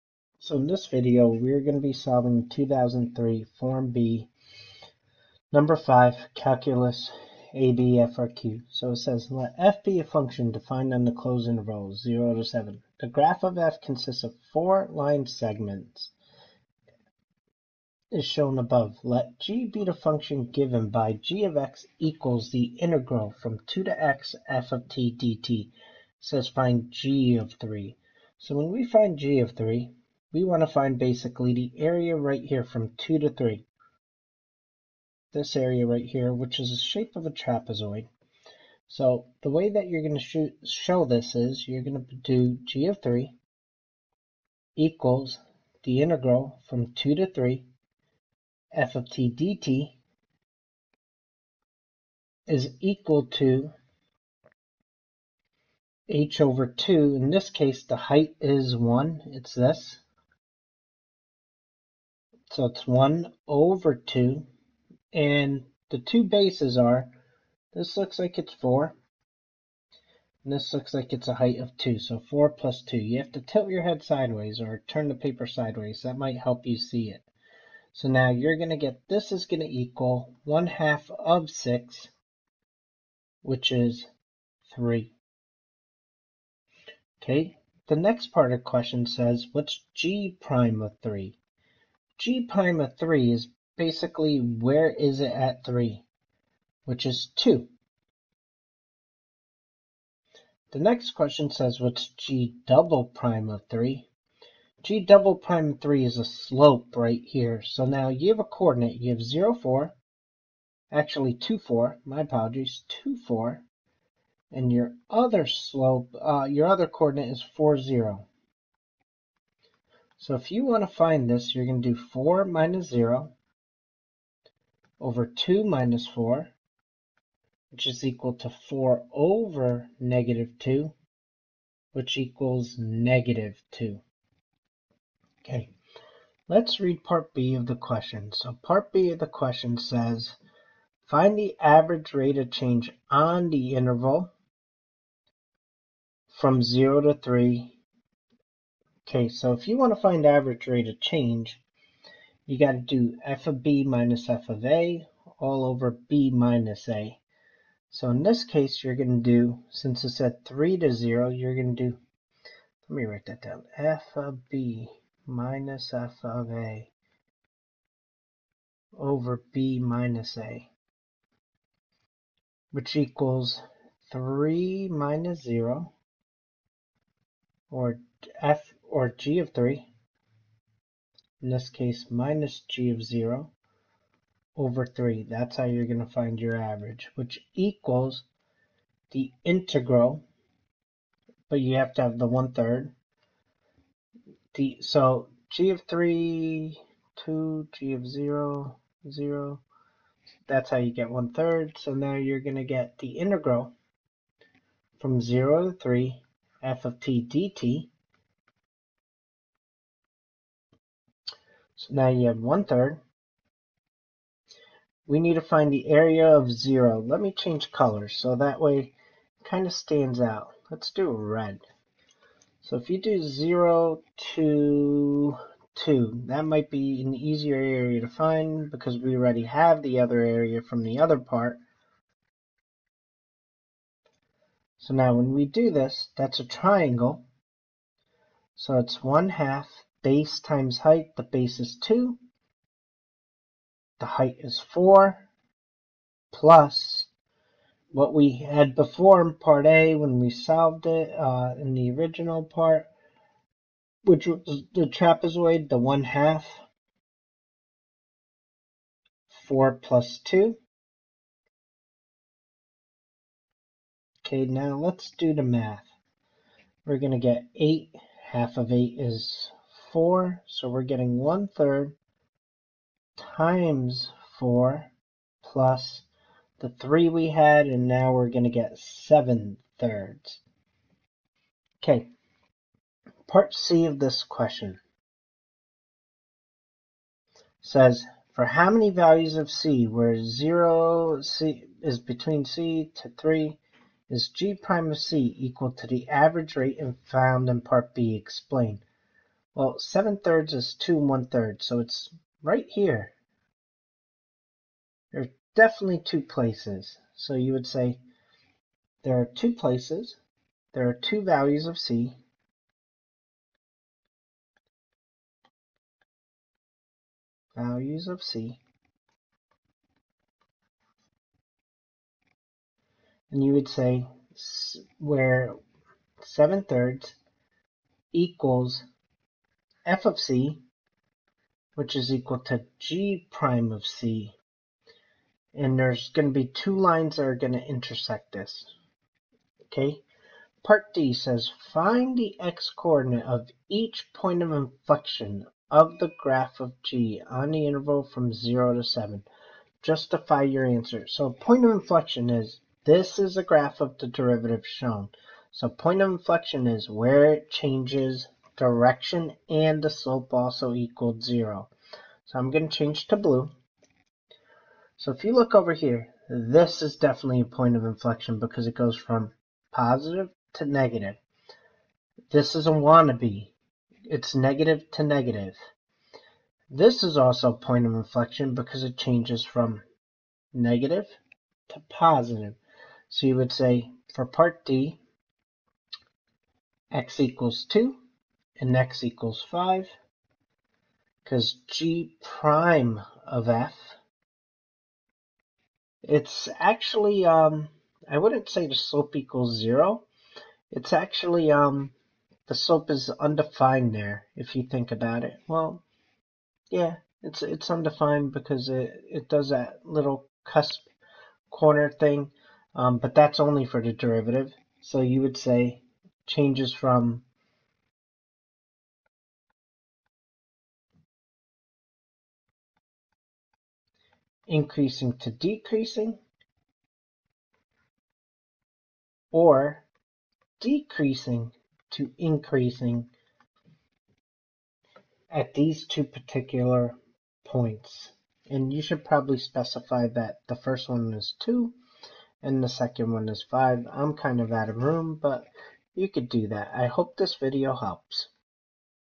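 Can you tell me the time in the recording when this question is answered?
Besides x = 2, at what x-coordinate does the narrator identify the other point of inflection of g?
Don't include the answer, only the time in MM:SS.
06:28.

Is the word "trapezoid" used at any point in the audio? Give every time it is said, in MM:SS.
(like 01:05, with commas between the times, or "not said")
00:37, 04:14.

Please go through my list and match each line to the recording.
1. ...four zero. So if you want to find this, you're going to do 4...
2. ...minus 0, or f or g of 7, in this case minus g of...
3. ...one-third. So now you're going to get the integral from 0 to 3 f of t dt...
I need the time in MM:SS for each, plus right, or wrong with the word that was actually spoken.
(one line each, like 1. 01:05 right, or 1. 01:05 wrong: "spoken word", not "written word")
1. 01:57 right
2. 02:54 wrong: "3", not "7"
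3. 03:21 right.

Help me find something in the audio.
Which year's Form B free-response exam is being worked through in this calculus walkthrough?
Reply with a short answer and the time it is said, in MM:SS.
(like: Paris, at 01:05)
2003, at 00:02.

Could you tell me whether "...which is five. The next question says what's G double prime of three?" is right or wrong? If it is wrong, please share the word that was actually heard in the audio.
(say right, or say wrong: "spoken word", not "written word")
wrong: "two", not "five".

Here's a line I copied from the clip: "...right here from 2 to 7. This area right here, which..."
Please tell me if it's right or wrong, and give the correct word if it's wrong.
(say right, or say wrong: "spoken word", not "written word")
wrong: "3", not "7".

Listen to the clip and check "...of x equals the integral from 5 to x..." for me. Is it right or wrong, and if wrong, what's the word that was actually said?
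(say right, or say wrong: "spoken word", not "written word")
wrong: "2", not "5".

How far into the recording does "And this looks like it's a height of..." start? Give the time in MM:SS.
01:10.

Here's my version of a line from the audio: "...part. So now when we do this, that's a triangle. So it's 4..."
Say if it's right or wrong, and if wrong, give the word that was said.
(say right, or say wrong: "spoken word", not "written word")
wrong: "1", not "4".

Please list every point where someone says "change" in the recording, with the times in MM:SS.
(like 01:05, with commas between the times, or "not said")
02:22, 02:31, 03:37, 05:57, 06:02, 06:18, 06:56.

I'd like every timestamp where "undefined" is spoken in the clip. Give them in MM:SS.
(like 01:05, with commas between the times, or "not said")
06:43, 06:47.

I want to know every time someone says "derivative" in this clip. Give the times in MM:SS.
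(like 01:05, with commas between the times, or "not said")
05:54, 06:53.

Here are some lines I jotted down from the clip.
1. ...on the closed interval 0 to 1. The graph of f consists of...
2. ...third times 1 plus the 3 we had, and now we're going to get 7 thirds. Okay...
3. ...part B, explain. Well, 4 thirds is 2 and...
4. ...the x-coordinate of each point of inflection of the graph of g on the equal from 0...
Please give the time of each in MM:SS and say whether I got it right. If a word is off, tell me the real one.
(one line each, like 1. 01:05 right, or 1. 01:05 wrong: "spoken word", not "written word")
1. 00:10 wrong: "7", not "1"
2. 04:31 wrong: "4", not "1"
3. 04:57 wrong: "7", not "4"
4. 05:42 wrong: "interval", not "equal".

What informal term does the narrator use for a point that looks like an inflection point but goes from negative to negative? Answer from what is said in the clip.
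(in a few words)
wannabe.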